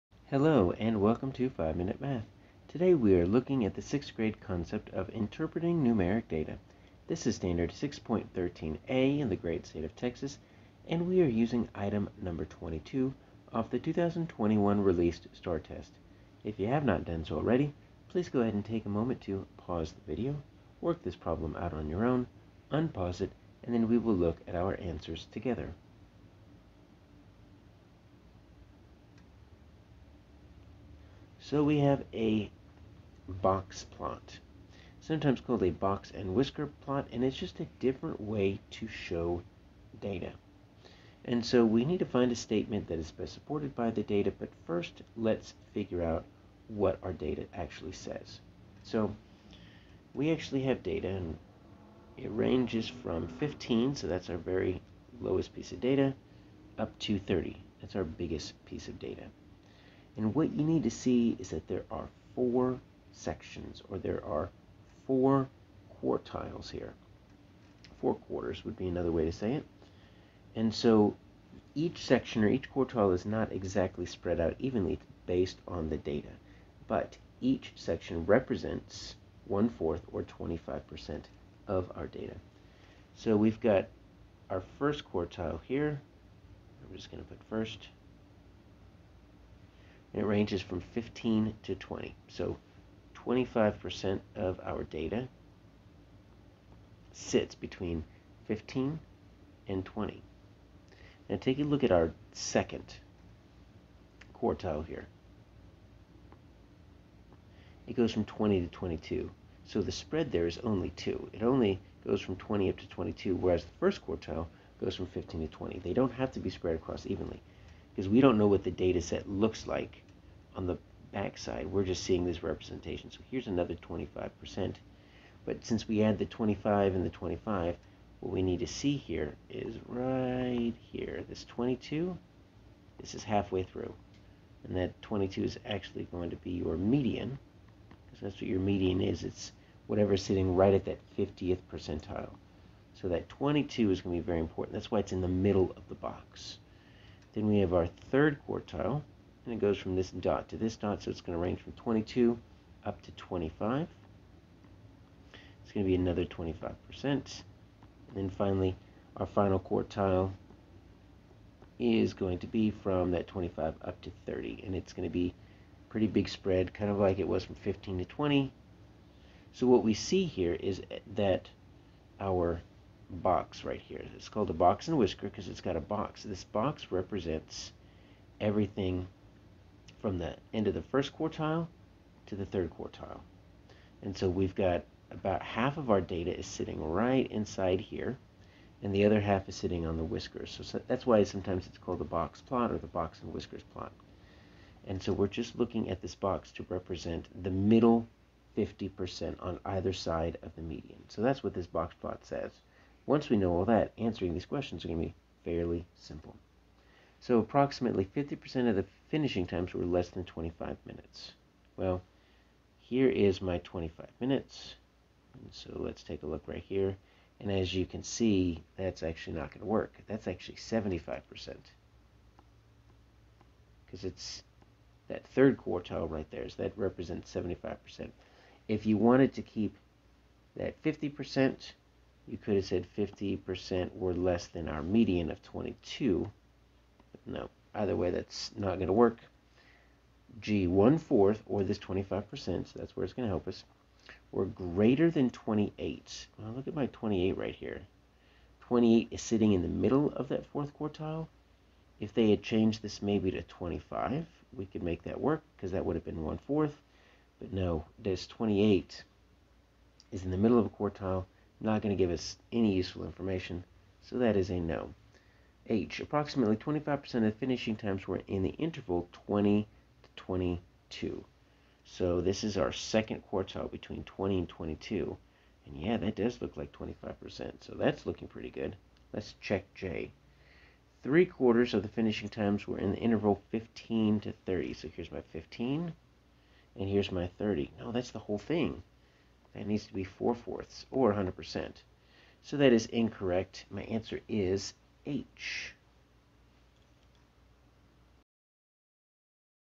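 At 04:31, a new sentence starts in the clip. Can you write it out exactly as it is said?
So this is our second quartile between 20 and 22.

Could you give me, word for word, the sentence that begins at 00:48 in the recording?
So we actually have data, and it ranges from 15, so that's our very lowest piece of data, up to 30.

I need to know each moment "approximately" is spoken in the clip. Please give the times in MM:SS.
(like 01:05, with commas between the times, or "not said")
03:27, 04:25.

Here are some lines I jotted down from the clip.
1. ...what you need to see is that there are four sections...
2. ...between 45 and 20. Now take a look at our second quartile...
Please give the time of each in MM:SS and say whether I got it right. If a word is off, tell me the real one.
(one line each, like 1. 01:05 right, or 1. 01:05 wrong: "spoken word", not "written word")
1. 01:00 right
2. 01:37 wrong: "15", not "45".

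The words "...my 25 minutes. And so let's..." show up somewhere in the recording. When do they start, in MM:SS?
03:33.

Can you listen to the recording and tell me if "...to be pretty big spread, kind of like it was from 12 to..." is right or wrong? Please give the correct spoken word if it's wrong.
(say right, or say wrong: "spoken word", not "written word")
wrong: "15", not "12".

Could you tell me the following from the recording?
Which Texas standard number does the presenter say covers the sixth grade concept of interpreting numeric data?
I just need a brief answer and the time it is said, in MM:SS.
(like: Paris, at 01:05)
6.13a, at 00:07.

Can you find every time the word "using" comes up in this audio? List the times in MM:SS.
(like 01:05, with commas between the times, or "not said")
00:11.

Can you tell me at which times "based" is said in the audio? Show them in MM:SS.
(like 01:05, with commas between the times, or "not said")
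01:15.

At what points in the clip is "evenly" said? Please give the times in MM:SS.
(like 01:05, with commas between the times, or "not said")
01:14, 01:57.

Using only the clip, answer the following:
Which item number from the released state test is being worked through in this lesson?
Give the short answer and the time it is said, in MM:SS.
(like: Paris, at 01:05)
22, at 00:11.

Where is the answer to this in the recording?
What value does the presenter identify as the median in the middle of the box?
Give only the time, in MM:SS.
02:14.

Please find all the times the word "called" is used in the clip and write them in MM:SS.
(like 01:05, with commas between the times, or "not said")
00:35, 02:54, 03:11.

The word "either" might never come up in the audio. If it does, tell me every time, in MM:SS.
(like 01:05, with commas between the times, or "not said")
03:19, 03:57.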